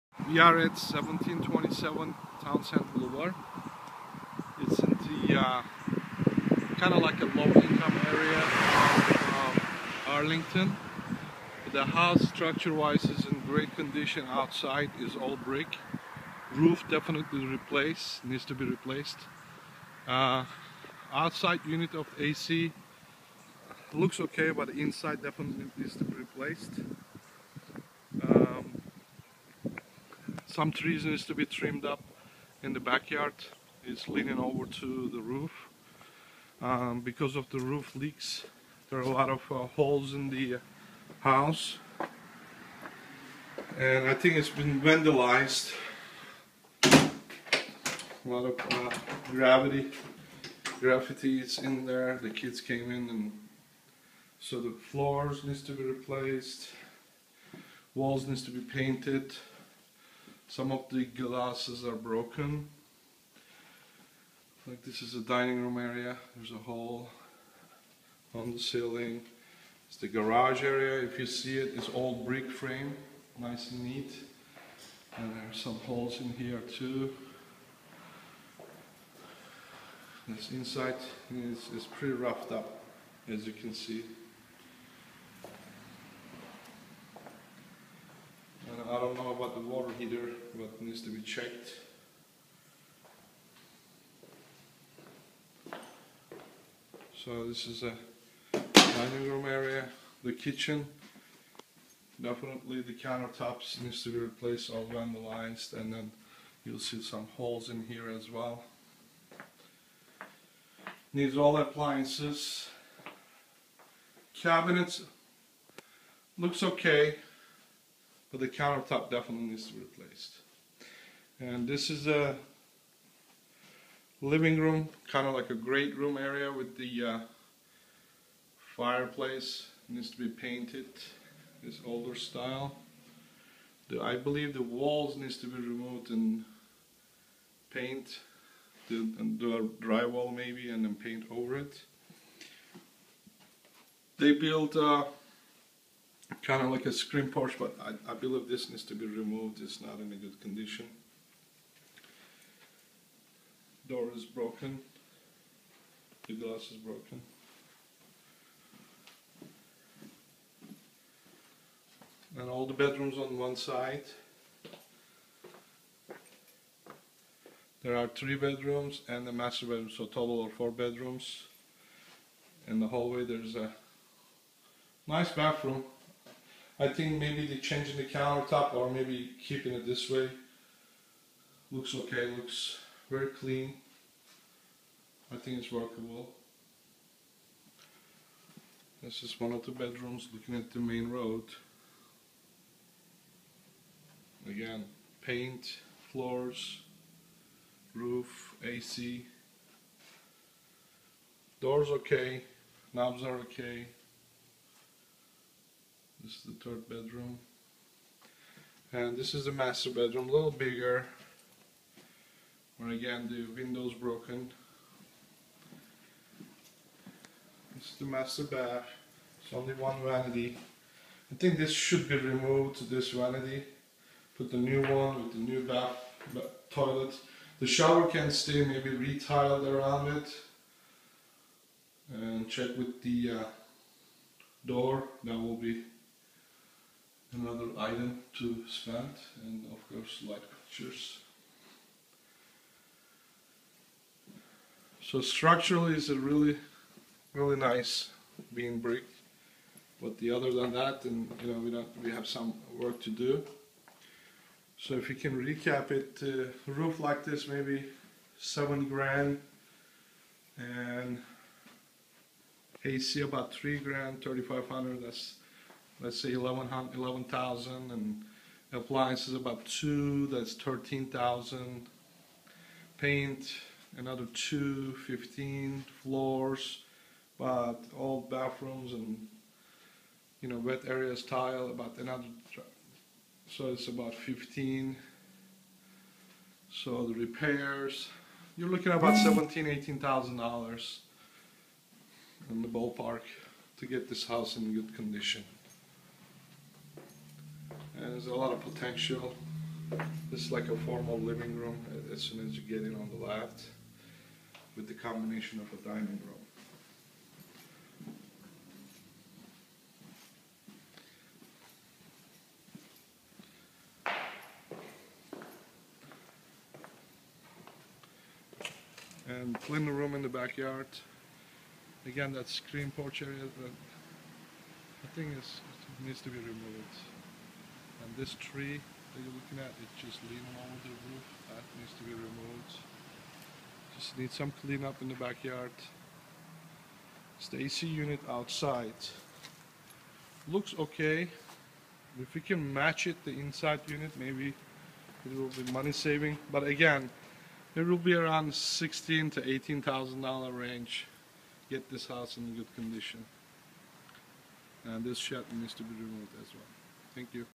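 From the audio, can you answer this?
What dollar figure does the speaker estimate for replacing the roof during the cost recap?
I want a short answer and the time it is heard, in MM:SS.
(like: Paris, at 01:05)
$7,000, at 04:18.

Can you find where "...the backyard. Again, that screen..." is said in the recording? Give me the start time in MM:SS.
05:20.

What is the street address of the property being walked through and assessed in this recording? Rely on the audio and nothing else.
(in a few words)
1727 Townsend Boulevard.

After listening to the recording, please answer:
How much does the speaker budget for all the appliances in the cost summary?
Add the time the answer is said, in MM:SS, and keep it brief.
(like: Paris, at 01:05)
$2,000, at 04:28.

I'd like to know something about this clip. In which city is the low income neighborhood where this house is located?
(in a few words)
Arlington.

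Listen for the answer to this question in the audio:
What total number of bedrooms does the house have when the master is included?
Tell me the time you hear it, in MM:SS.
02:50.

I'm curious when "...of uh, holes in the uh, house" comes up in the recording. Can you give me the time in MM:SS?
00:39.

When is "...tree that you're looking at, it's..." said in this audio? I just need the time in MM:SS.
05:28.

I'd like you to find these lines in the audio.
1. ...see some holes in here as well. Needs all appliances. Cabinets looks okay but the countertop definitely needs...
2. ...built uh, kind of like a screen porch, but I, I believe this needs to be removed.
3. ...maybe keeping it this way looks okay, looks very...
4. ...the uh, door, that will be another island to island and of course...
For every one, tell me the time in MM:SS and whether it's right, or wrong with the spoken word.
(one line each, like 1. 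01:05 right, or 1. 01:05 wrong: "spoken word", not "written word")
1. 01:46 right
2. 02:24 right
3. 02:58 right
4. 03:53 wrong: "spend", not "island".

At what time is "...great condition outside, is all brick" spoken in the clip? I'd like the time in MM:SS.
00:13.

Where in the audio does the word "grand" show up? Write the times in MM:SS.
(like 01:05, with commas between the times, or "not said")
04:18, 04:23.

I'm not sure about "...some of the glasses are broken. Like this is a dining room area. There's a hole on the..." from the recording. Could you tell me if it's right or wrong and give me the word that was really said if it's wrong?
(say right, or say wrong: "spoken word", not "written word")
right.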